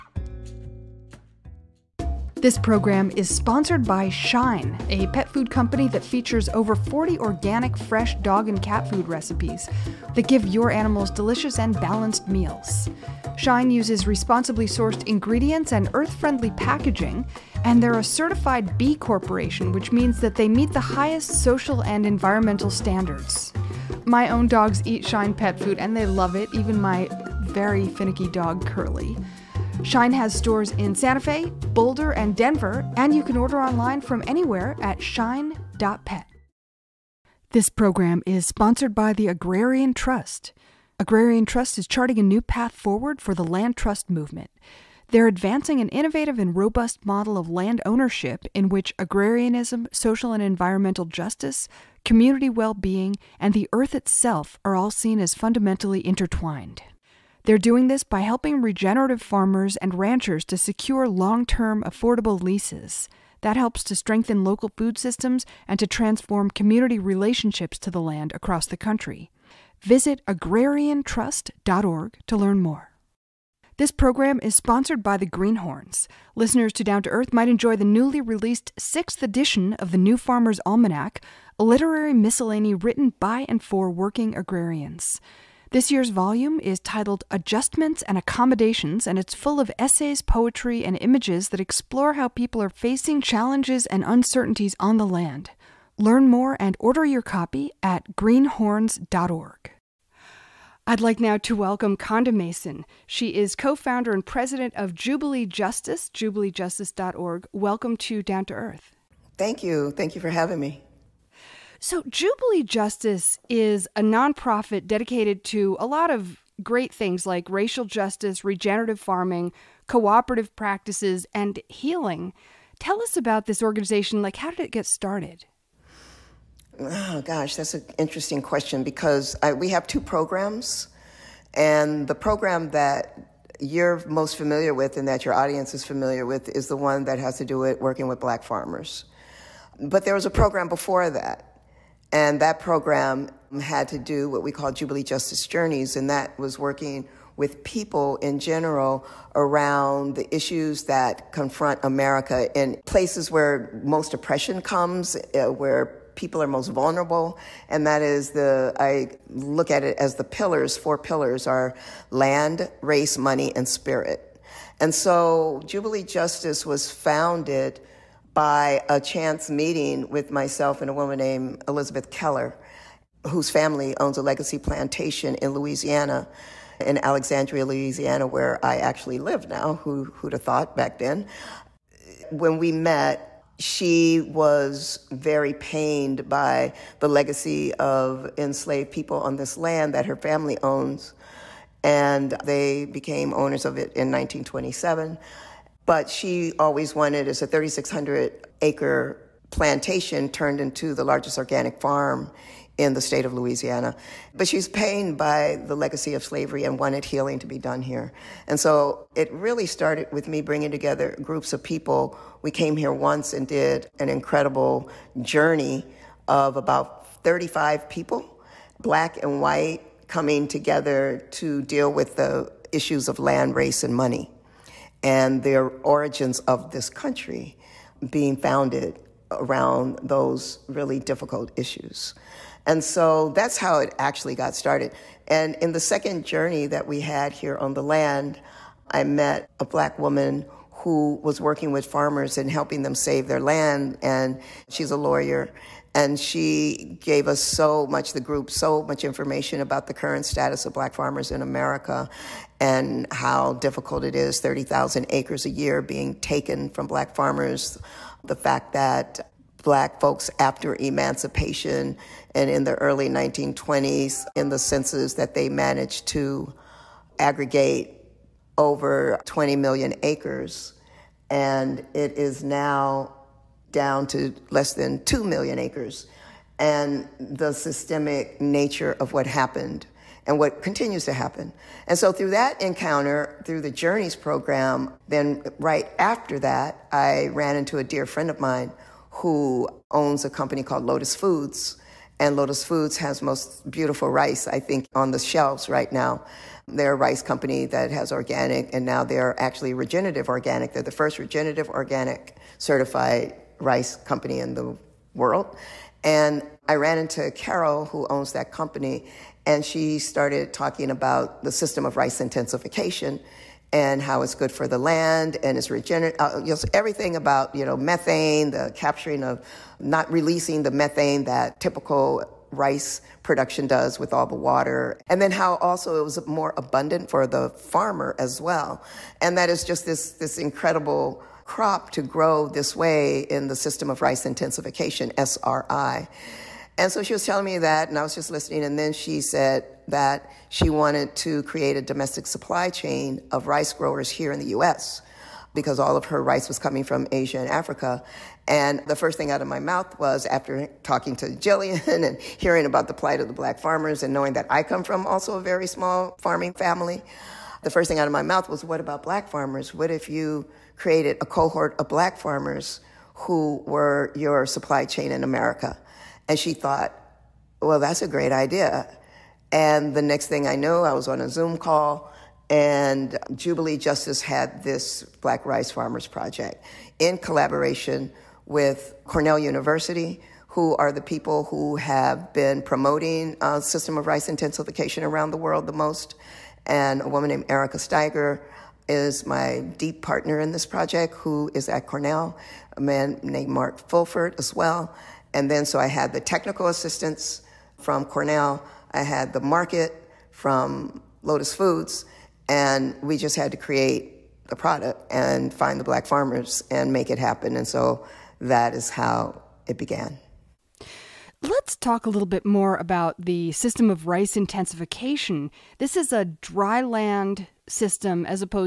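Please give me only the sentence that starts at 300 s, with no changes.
They're the first regenerative organic certified rice company in the world.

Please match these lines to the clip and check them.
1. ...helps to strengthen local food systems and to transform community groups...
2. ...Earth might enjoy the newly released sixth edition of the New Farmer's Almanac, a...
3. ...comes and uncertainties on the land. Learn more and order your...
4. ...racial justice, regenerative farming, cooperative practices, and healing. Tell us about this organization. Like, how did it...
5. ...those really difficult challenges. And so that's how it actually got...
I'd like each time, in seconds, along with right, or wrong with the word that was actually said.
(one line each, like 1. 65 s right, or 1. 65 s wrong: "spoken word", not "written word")
1. 63 s wrong: "relationships", not "groups"
2. 77 s right
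3. 93 s wrong: "challenges", not "comes"
4. 117 s right
5. 230 s wrong: "issues", not "challenges".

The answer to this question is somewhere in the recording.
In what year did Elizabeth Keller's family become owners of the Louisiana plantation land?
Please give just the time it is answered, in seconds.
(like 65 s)
194 s.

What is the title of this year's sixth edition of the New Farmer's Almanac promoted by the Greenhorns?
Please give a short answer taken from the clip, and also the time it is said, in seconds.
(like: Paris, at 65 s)
Adjustments and Accommodations, at 87 s.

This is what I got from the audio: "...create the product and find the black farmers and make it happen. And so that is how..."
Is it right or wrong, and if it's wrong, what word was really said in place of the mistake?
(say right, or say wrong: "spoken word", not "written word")
right.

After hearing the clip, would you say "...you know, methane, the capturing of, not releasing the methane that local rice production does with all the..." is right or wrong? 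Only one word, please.
wrong.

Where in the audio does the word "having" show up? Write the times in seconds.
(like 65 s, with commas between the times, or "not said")
110 s.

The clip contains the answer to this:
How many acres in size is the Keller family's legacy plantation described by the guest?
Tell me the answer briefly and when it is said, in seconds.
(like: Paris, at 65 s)
3,600, at 197 s.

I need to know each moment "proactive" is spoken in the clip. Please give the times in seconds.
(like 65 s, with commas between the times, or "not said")
not said.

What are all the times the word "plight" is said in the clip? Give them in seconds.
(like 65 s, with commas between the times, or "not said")
352 s.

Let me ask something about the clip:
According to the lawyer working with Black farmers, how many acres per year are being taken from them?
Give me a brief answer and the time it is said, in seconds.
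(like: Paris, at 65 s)
30,000, at 254 s.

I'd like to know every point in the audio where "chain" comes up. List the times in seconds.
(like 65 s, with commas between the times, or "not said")
342 s, 364 s.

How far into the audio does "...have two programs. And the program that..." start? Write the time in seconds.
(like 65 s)
129 s.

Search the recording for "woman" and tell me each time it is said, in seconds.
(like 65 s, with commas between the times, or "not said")
170 s, 239 s, 387 s.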